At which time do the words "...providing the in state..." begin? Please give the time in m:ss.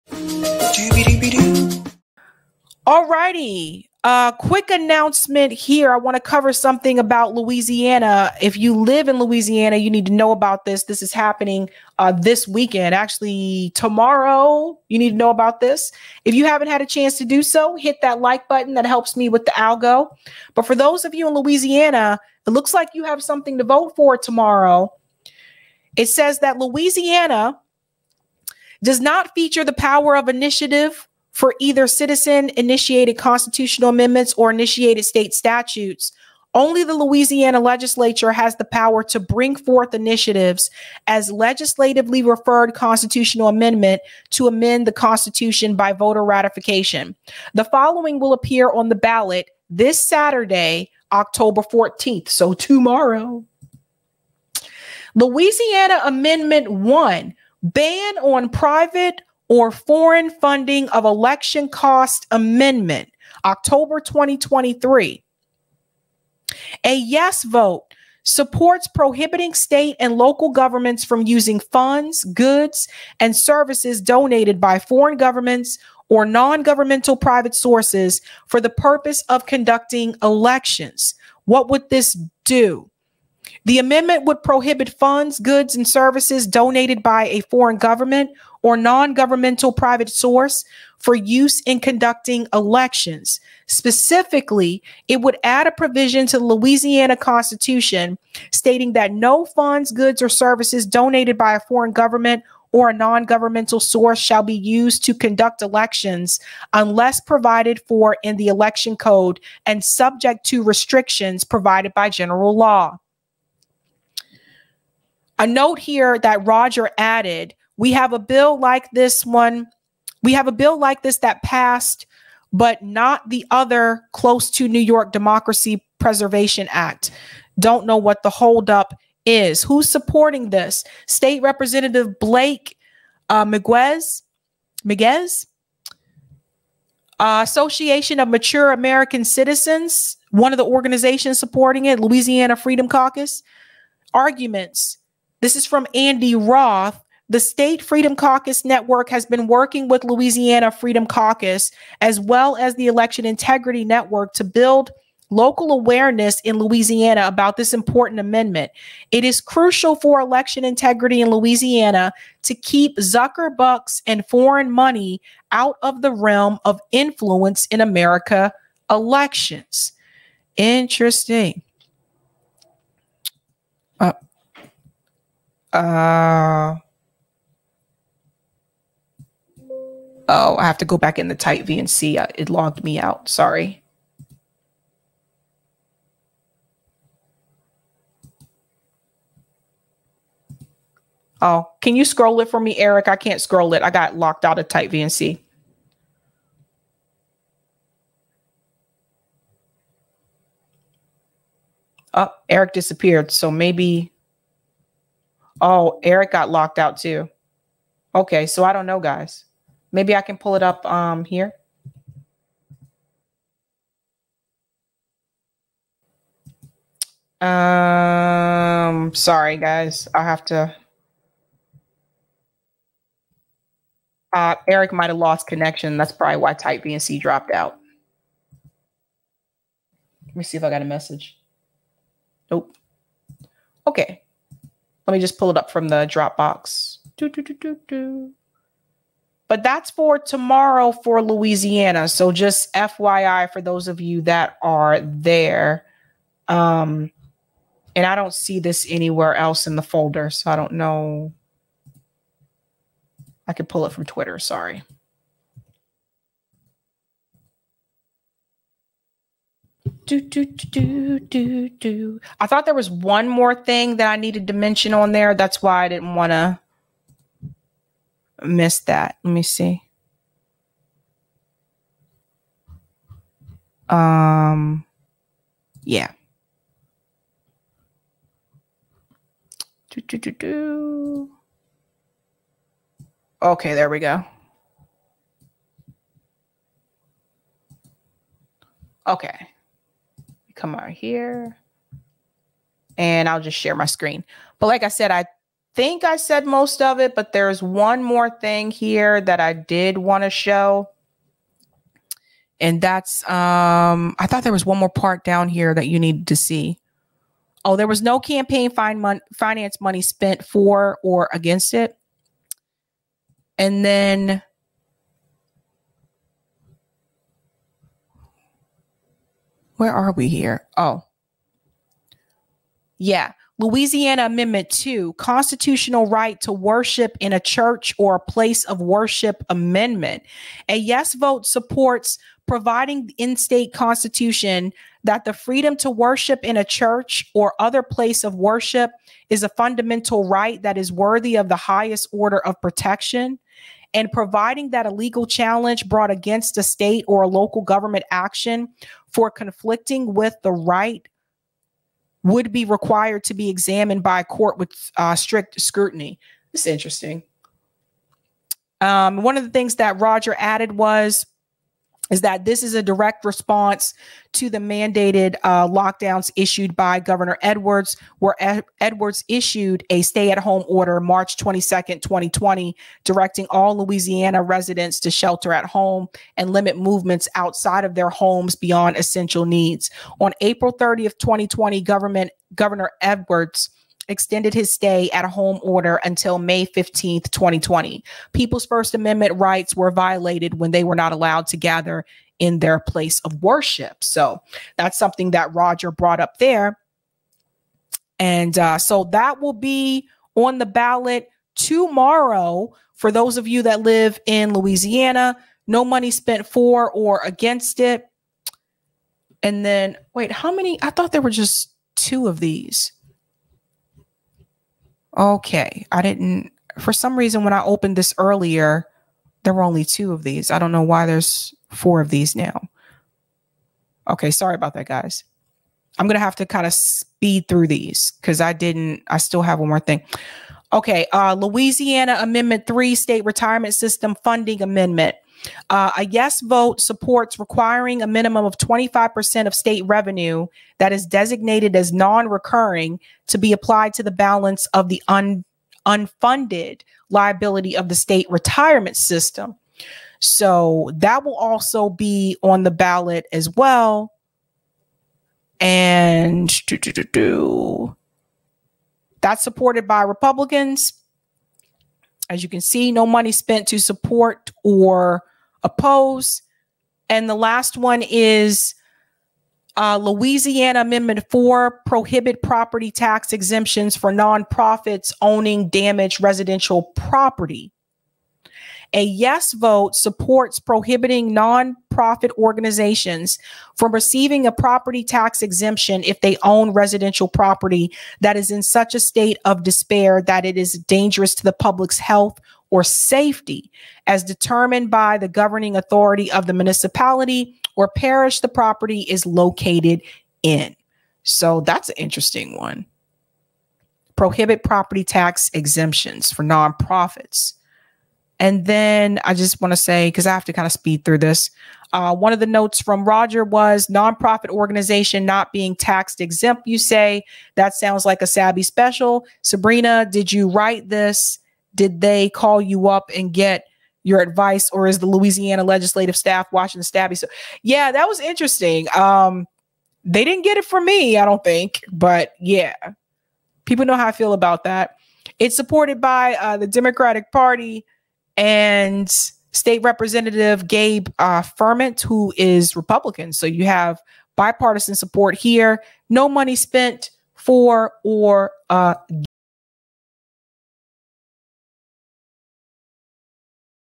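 5:32.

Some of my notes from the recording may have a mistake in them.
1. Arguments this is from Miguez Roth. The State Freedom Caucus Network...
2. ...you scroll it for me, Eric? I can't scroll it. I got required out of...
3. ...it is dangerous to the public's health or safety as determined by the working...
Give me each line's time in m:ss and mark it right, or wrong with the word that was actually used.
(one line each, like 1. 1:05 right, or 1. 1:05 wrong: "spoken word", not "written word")
1. 2:24 wrong: "Andy", not "Miguez"
2. 3:11 wrong: "locked", not "required"
3. 8:10 wrong: "governing", not "working".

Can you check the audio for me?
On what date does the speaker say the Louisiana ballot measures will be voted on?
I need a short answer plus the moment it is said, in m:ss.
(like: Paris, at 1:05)
Saturday, October 14th, at 0:50.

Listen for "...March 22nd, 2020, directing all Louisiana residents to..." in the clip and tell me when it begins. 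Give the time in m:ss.
6:10.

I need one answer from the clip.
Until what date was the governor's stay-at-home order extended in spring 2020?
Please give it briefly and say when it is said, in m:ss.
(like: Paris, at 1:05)
May 15th, 2020, at 6:26.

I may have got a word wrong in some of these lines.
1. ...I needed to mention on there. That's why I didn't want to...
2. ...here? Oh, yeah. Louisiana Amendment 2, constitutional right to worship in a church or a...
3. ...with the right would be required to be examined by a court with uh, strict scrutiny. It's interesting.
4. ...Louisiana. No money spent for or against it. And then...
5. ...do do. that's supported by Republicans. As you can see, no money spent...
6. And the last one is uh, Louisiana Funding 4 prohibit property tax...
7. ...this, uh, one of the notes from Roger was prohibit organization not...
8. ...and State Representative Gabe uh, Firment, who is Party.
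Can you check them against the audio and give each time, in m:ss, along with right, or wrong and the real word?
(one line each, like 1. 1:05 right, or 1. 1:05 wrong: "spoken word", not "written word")
1. 4:24 right
2. 5:20 right
3. 5:50 right
4. 6:44 right
5. 7:36 right
6. 7:47 wrong: "Amendment", not "Funding"
7. 8:31 wrong: "nonprofit", not "prohibit"
8. 8:58 wrong: "Republican", not "Party".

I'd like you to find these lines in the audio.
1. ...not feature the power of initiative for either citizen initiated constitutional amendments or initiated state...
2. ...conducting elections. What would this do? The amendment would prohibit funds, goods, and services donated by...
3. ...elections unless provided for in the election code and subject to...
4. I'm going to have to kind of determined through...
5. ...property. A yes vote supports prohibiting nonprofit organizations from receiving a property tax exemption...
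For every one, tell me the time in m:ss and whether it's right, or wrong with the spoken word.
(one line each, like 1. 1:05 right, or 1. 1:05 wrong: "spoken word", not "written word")
1. 0:28 right
2. 1:19 right
3. 1:45 right
4. 7:05 wrong: "speed", not "determined"
5. 7:56 right.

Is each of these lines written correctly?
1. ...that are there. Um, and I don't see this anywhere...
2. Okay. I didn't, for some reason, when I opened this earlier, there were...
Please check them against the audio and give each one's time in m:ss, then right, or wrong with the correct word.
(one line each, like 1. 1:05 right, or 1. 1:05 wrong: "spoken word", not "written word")
1. 4:04 right
2. 6:55 right.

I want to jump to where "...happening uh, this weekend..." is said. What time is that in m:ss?
0:11.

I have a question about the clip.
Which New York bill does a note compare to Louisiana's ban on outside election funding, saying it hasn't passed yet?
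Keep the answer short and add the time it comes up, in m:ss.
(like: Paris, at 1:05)
Democracy Preservation Act, at 2:05.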